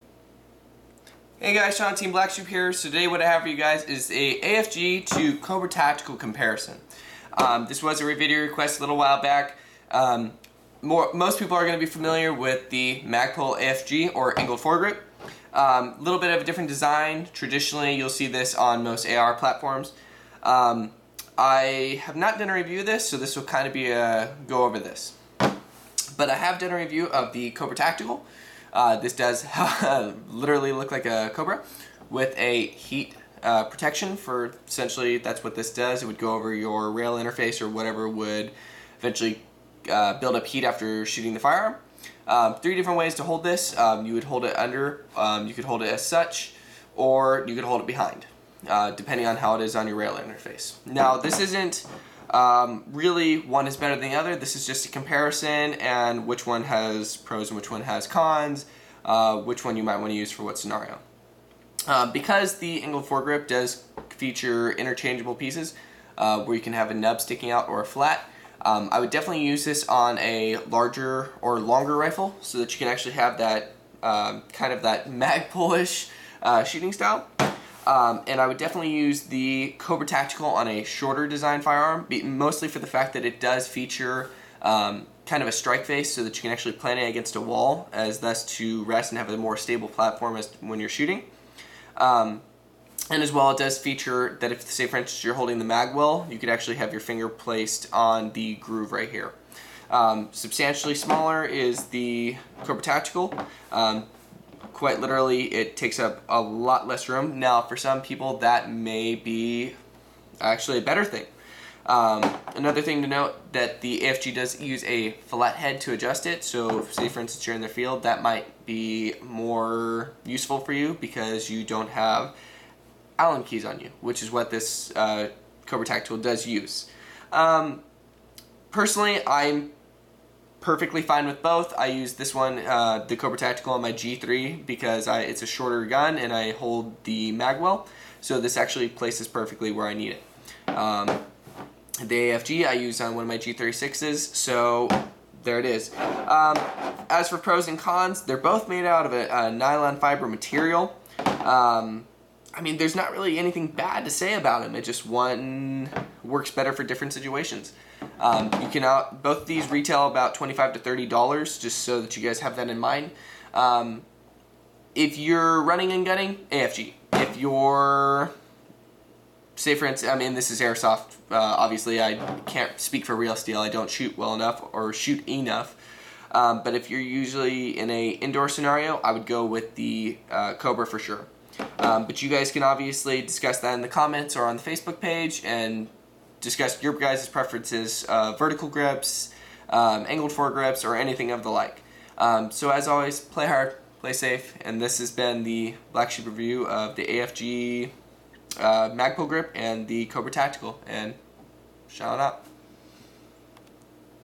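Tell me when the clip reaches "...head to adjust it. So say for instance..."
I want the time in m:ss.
1:55.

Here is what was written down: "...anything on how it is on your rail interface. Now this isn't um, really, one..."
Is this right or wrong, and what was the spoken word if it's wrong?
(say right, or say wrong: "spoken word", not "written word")
wrong: "depending", not "anything".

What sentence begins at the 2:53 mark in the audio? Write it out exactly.
I don't shoot well enough or shoot enough.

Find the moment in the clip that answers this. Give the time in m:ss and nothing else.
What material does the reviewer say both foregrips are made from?
2:29.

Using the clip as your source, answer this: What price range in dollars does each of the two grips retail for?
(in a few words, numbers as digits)
$25 to $30.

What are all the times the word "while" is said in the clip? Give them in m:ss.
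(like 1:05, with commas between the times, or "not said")
0:08.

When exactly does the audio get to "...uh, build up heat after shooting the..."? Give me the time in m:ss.
0:39.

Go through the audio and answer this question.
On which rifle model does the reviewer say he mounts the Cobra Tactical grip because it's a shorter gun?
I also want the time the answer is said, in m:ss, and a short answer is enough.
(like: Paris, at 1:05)
G3, at 2:13.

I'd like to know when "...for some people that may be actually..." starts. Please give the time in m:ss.
1:47.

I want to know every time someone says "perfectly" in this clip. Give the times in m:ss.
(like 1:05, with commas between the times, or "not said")
2:10, 2:19.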